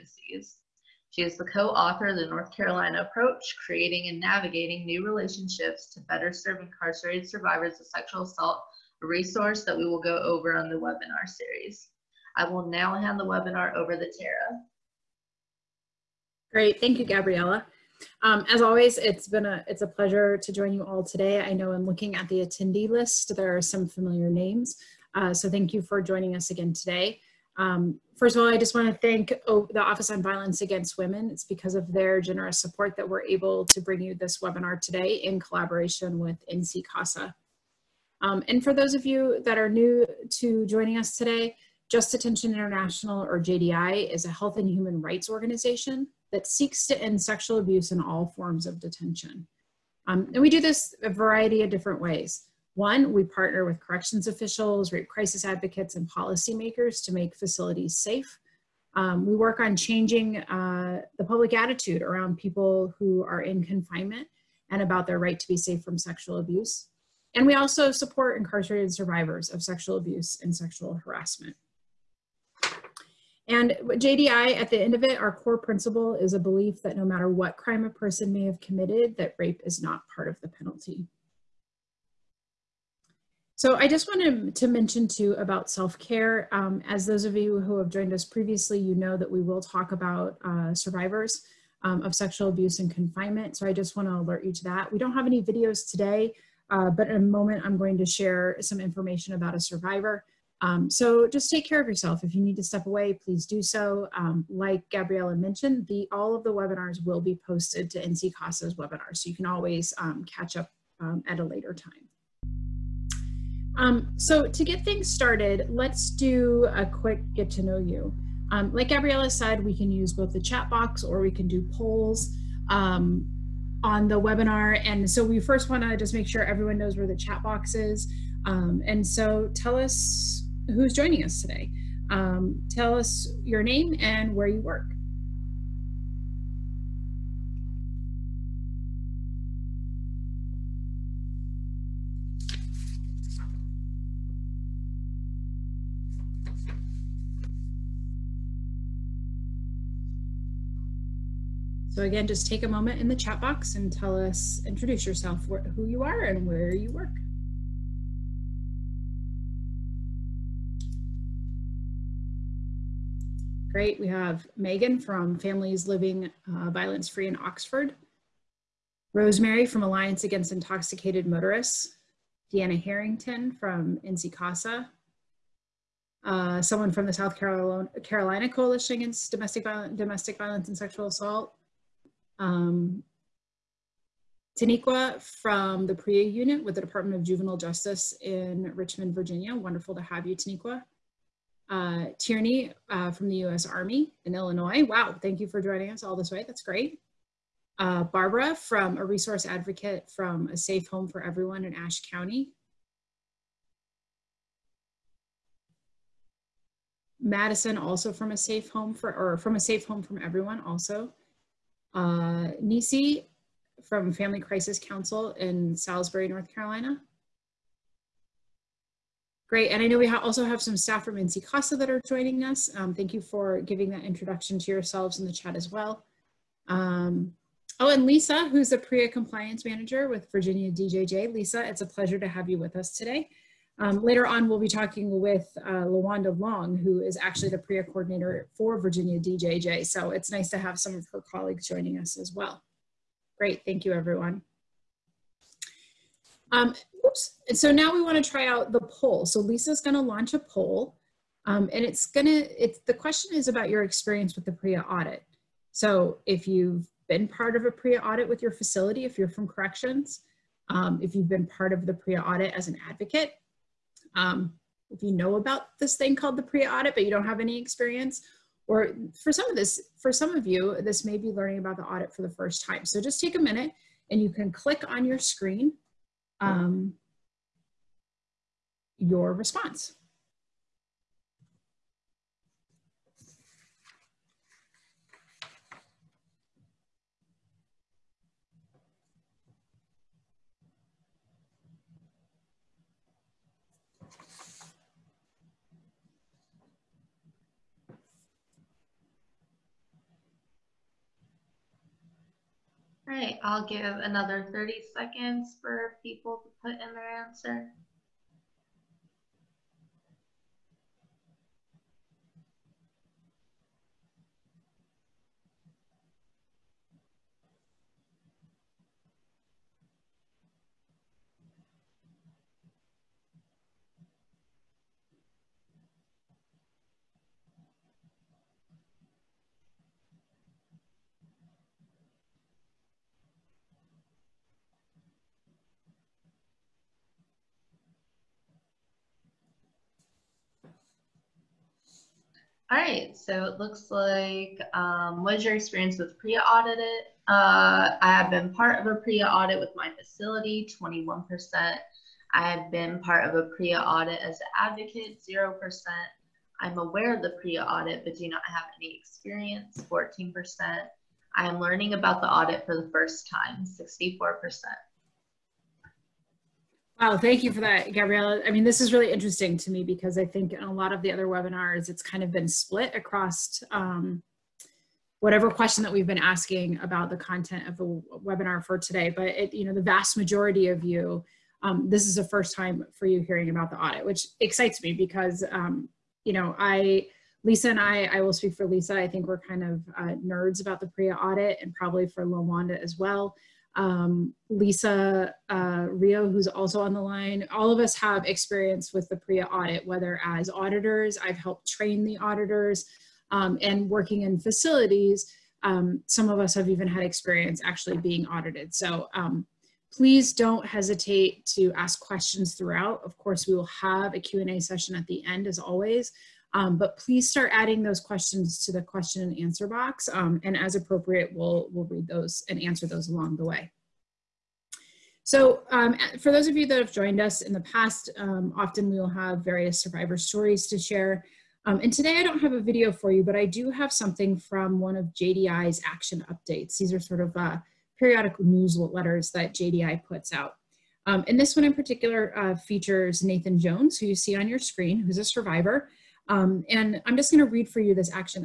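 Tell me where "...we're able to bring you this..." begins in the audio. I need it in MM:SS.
00:33.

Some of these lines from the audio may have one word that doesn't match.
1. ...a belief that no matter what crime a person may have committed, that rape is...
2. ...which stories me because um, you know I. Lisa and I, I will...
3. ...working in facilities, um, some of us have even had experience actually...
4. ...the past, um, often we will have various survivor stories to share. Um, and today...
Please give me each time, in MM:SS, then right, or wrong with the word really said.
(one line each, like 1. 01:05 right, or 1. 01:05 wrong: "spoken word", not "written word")
1. 01:16 right
2. 06:24 wrong: "excites", not "stories"
3. 06:43 right
4. 07:07 right.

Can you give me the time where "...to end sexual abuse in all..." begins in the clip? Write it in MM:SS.
00:46.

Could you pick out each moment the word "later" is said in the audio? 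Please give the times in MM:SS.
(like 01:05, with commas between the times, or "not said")
01:51, 03:54.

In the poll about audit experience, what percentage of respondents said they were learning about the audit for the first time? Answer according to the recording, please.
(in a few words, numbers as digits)
64%.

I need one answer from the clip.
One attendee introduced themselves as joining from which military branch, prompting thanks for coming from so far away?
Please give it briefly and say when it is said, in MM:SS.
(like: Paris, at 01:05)
U.S. Army, at 03:13.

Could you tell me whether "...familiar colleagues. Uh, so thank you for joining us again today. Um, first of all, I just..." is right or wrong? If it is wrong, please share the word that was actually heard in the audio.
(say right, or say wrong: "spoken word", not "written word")
wrong: "names", not "colleagues".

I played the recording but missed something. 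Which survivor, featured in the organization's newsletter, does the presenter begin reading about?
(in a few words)
Nathan Jones.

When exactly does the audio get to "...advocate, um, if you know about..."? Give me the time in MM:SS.
04:22.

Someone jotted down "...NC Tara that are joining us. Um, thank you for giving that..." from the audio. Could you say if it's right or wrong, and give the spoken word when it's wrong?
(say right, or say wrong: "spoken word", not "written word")
wrong: "CASA", not "Tara".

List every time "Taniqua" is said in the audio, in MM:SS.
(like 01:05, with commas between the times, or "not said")
03:04, 03:10.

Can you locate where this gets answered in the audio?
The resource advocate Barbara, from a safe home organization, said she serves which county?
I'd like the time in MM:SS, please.
03:21.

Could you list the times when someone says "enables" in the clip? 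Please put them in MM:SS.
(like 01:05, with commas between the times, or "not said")
not said.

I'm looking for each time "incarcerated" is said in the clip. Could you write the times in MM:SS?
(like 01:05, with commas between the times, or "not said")
00:06, 01:08.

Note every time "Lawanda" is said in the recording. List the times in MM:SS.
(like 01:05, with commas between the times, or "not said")
03:55, 06:32.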